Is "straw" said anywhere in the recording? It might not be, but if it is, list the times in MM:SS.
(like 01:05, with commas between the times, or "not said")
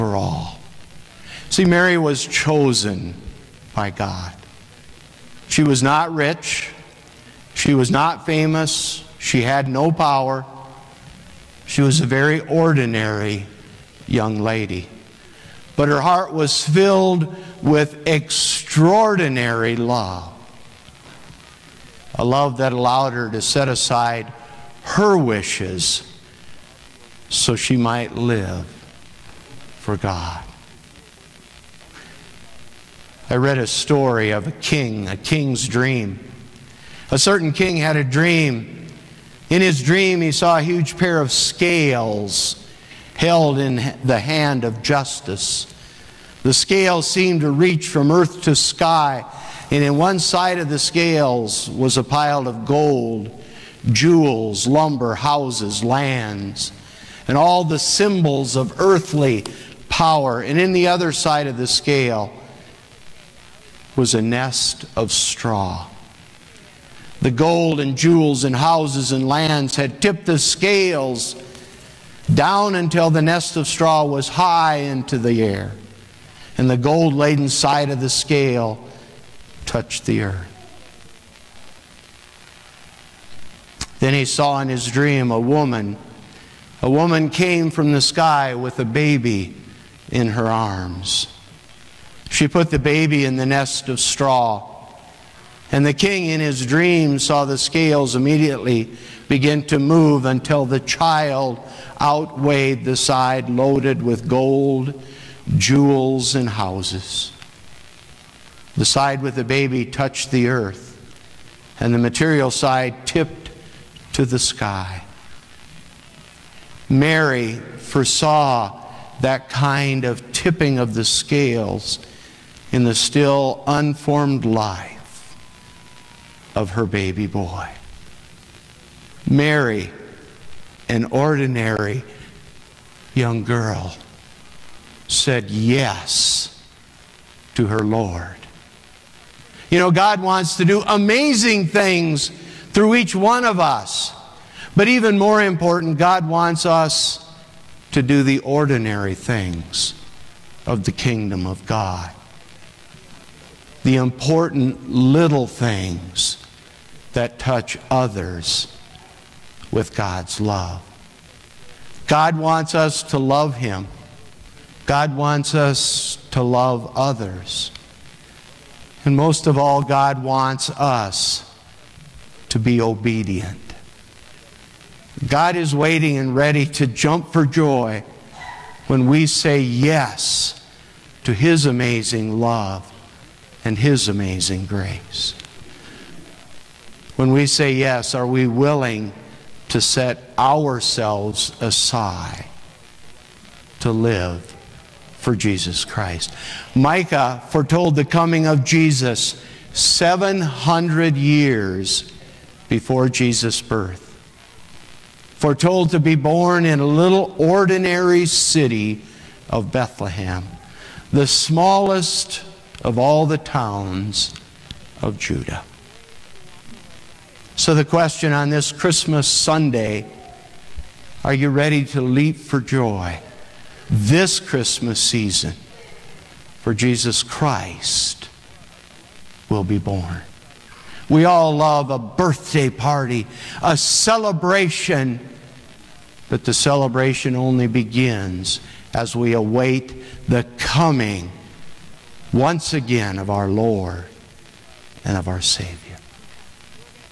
01:05, 01:13, 01:33.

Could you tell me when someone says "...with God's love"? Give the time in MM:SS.
02:39.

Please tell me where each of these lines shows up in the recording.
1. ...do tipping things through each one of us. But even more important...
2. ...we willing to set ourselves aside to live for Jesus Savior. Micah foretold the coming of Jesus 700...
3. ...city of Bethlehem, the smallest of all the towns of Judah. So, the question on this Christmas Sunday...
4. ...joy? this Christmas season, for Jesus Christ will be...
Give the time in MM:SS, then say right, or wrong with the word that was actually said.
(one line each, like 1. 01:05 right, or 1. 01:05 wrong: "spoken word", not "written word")
1. 02:20 wrong: "amazing", not "tipping"
2. 03:08 wrong: "Christ", not "Savior"
3. 03:28 right
4. 03:42 right.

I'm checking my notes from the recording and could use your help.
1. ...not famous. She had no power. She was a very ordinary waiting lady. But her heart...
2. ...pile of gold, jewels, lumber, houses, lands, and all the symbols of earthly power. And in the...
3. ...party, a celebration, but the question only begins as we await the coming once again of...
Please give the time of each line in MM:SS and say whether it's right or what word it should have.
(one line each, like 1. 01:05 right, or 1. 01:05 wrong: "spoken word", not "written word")
1. 00:07 wrong: "young", not "waiting"
2. 00:52 right
3. 03:52 wrong: "celebration", not "question".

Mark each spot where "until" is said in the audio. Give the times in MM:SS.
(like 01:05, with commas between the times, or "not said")
01:12, 01:40.